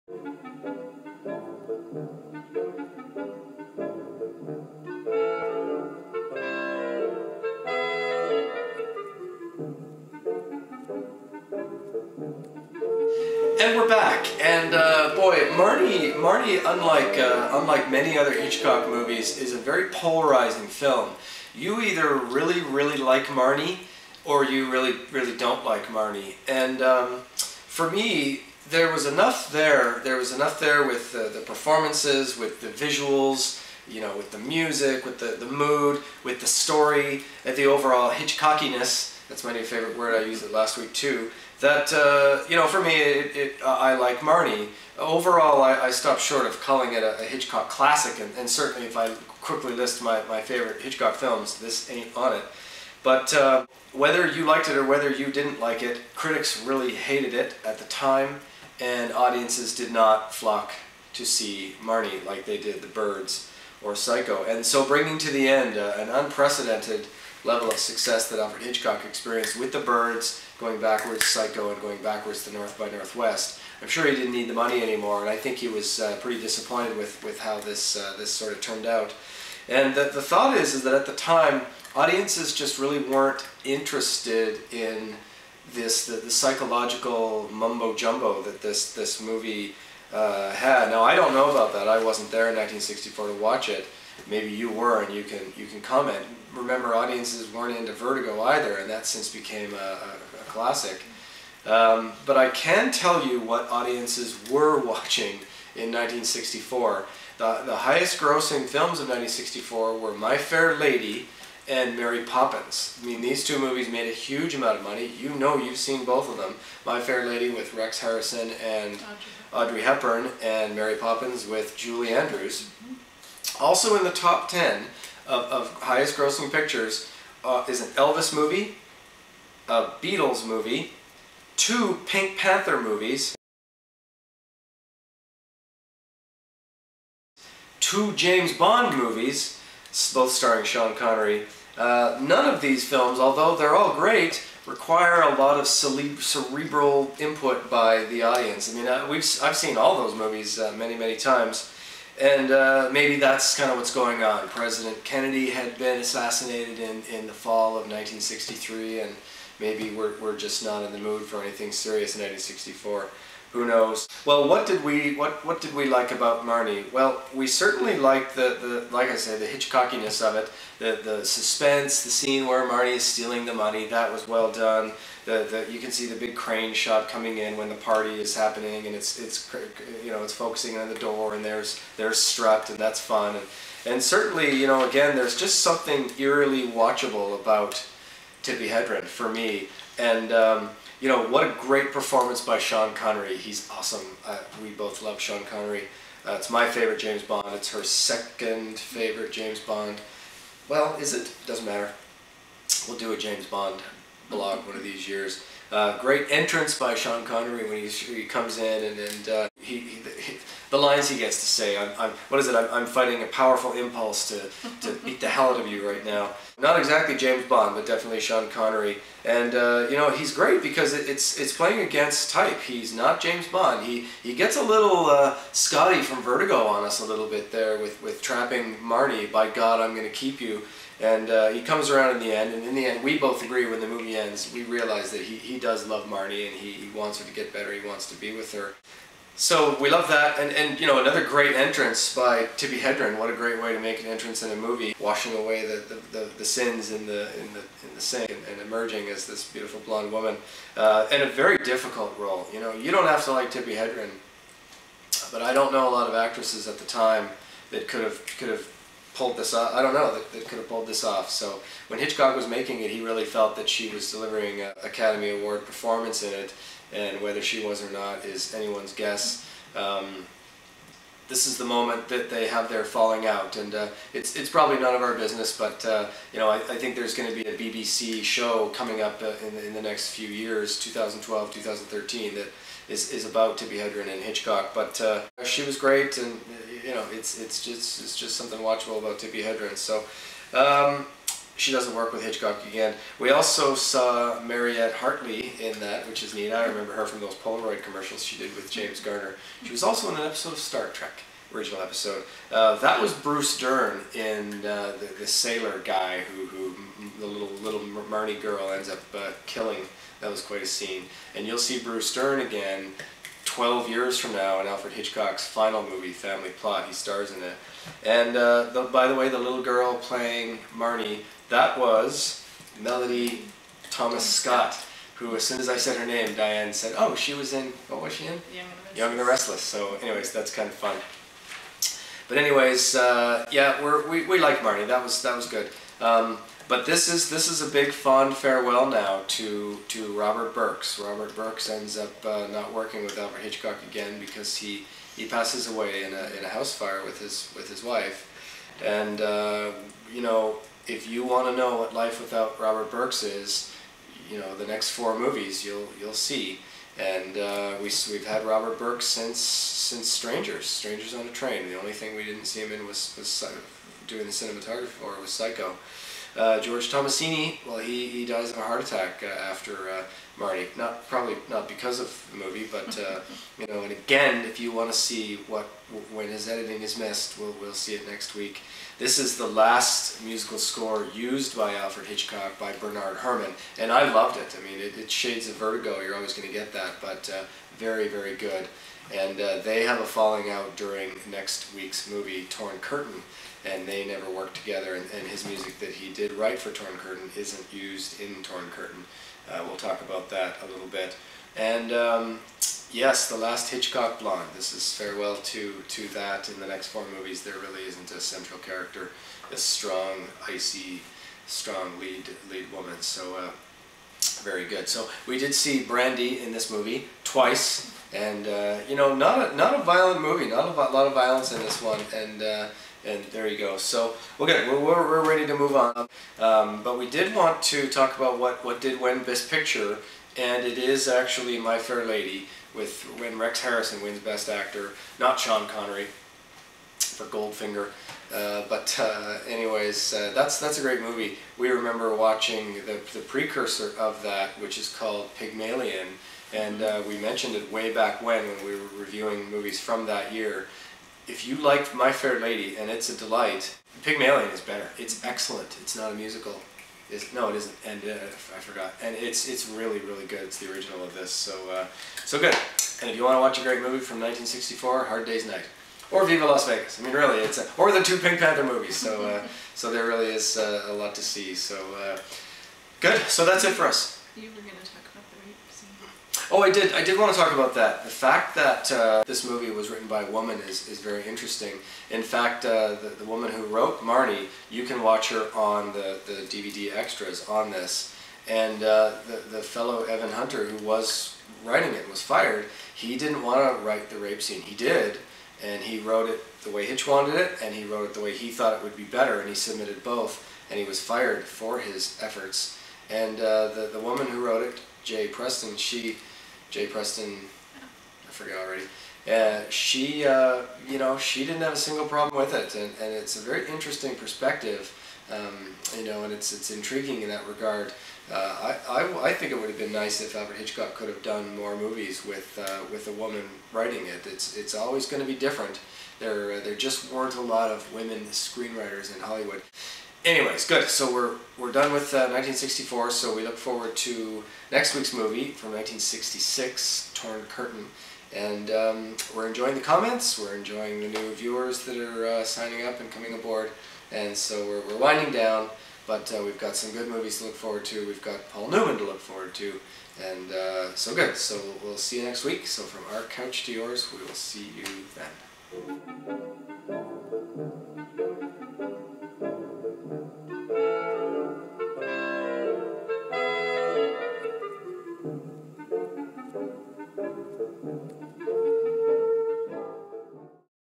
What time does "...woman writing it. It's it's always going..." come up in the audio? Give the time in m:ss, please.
8:43.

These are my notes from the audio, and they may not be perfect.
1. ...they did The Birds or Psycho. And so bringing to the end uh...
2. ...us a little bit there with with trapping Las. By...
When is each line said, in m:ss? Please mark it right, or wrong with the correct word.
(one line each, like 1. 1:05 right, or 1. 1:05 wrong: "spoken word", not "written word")
1. 1:02 right
2. 3:46 wrong: "Marnie", not "Las".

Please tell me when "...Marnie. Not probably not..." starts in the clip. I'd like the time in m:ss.
6:10.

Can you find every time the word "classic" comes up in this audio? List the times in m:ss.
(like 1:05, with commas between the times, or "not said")
0:47, 1:40.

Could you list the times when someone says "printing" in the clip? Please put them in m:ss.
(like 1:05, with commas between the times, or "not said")
not said.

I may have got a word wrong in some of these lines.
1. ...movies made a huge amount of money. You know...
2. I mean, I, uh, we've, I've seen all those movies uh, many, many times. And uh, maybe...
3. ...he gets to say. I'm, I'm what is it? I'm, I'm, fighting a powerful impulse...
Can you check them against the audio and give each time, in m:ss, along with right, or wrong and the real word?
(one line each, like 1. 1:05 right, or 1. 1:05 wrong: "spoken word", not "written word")
1. 1:53 right
2. 2:28 right
3. 3:31 right.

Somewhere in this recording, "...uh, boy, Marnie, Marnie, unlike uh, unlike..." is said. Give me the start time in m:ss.
0:14.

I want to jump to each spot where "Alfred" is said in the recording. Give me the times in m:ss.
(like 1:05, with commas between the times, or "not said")
1:08, 5:14, 5:43, 6:21, 8:40.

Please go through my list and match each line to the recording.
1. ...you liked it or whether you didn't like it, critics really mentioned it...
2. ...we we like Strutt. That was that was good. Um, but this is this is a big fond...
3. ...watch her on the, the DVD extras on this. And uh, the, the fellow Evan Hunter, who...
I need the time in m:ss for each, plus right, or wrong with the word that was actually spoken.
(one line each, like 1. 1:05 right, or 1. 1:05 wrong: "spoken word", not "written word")
1. 0:54 wrong: "hated", not "mentioned"
2. 5:34 wrong: "Marnie", not "Strutt"
3. 8:05 right.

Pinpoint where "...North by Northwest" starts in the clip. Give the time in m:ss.
1:12.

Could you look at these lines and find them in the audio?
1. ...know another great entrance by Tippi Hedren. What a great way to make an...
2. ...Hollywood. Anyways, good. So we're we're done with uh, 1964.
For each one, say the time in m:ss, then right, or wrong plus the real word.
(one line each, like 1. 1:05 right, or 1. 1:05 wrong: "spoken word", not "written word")
1. 4:00 right
2. 8:49 right.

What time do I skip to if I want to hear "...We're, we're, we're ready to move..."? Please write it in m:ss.
7:04.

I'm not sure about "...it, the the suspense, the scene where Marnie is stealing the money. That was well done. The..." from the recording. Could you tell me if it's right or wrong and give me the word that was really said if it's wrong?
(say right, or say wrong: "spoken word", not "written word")
right.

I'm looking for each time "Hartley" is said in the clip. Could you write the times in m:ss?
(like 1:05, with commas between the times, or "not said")
4:54.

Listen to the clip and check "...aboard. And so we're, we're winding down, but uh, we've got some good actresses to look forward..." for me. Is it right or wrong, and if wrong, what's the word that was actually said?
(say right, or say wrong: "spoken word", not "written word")
wrong: "movies", not "actresses".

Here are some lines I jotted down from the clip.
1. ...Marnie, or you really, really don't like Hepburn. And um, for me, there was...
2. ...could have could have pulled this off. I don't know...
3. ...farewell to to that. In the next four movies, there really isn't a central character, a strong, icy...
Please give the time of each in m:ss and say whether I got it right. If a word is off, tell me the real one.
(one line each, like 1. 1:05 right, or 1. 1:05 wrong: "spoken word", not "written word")
1. 0:23 wrong: "Marnie", not "Hepburn"
2. 4:17 right
3. 6:44 right.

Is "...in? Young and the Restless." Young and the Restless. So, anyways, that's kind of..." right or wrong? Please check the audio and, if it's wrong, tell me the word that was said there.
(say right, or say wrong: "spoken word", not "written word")
right.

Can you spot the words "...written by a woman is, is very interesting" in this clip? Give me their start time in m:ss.
7:59.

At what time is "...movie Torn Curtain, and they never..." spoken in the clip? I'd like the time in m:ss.
6:32.